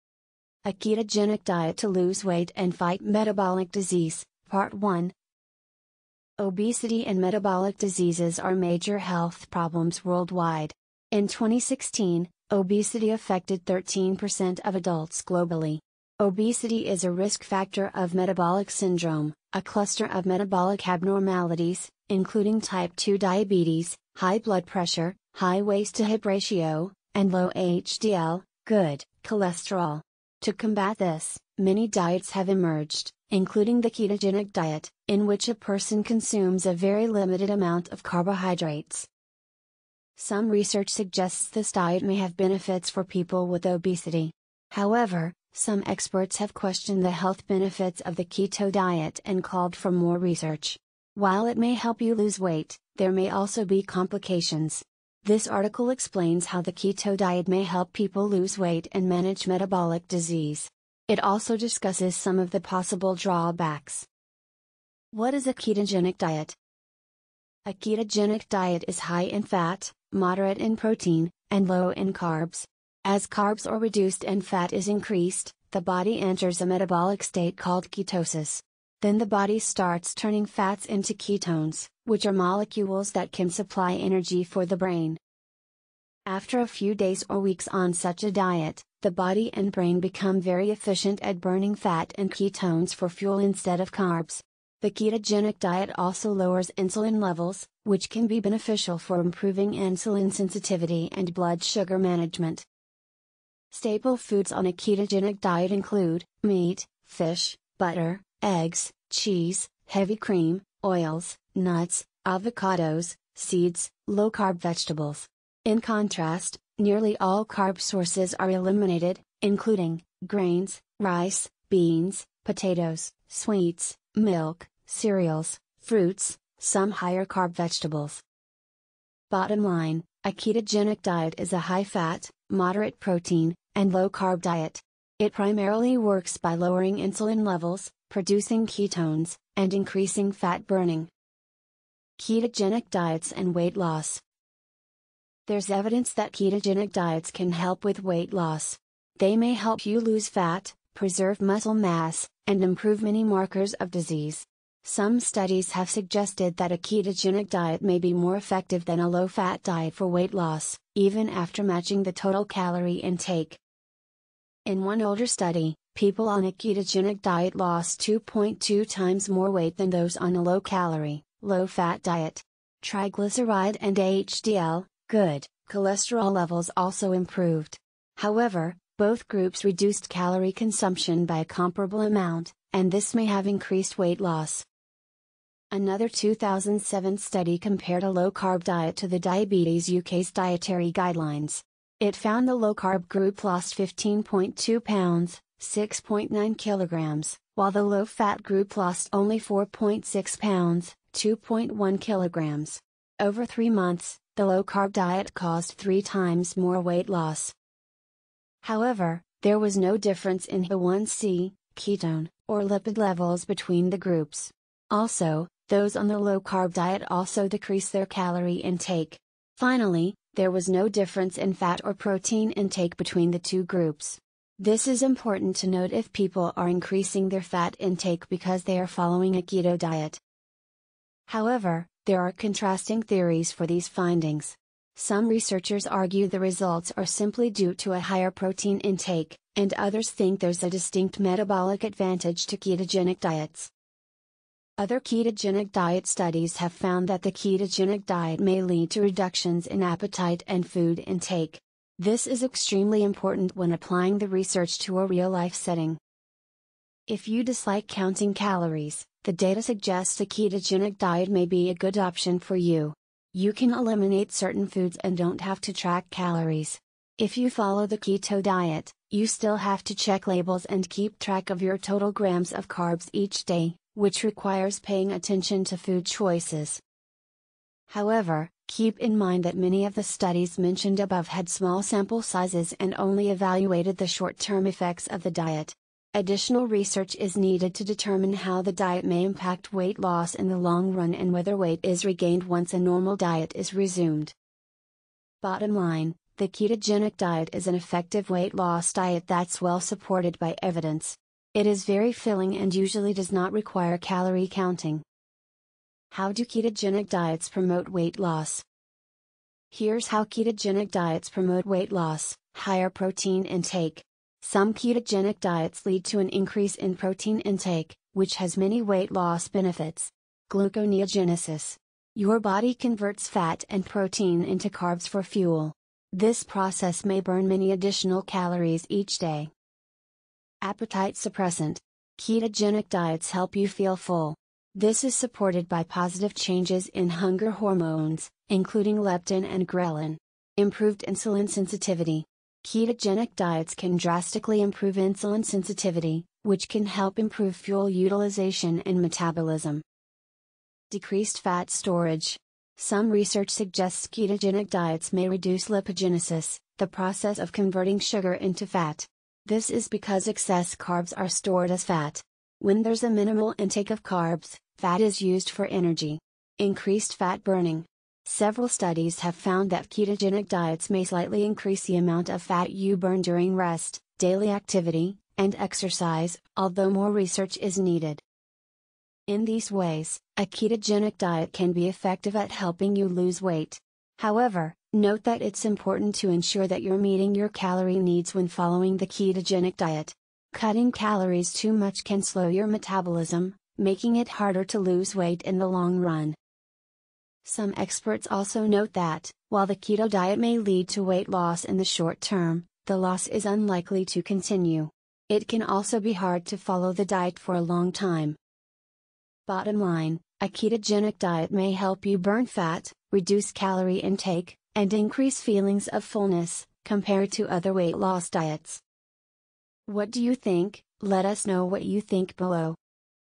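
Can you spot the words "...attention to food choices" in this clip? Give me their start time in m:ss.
4:35.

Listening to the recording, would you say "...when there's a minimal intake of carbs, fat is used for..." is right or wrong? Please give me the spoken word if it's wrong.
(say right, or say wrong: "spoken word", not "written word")
right.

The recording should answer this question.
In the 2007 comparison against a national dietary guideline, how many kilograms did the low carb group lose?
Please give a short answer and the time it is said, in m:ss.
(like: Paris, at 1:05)
6.9 kilograms, at 3:15.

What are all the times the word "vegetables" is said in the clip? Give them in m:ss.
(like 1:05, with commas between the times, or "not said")
1:54, 2:07.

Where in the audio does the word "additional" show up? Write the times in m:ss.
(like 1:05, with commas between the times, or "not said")
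4:46, 5:27.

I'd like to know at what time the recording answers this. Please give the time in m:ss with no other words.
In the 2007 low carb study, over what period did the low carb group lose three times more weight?
3:23.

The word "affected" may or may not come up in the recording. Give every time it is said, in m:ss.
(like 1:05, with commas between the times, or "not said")
0:13.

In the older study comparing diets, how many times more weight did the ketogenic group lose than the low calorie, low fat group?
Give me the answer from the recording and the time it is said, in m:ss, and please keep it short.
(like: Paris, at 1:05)
2.2 times, at 2:48.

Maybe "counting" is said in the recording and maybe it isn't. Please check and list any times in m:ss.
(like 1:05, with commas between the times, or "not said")
4:17, 5:04.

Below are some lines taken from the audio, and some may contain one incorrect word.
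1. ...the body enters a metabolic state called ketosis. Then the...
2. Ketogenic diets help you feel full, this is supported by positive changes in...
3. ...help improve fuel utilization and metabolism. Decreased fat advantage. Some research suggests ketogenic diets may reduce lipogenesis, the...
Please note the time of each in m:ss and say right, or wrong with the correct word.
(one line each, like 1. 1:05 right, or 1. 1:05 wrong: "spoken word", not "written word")
1. 1:15 right
2. 5:32 right
3. 5:46 wrong: "storage", not "advantage".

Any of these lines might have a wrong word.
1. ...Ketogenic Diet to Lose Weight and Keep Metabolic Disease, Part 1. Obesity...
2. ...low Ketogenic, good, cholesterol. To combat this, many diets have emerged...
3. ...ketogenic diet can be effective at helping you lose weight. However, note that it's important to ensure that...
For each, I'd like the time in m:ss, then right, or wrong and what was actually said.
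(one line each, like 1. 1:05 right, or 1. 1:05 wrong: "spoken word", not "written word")
1. 0:00 wrong: "Fight", not "Keep"
2. 0:27 wrong: "HDL", not "Ketogenic"
3. 6:20 right.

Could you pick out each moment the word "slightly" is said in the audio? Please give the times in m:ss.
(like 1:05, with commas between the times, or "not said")
6:11.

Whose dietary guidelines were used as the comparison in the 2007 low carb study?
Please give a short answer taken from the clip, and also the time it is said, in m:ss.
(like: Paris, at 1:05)
Diabetes UK, at 3:09.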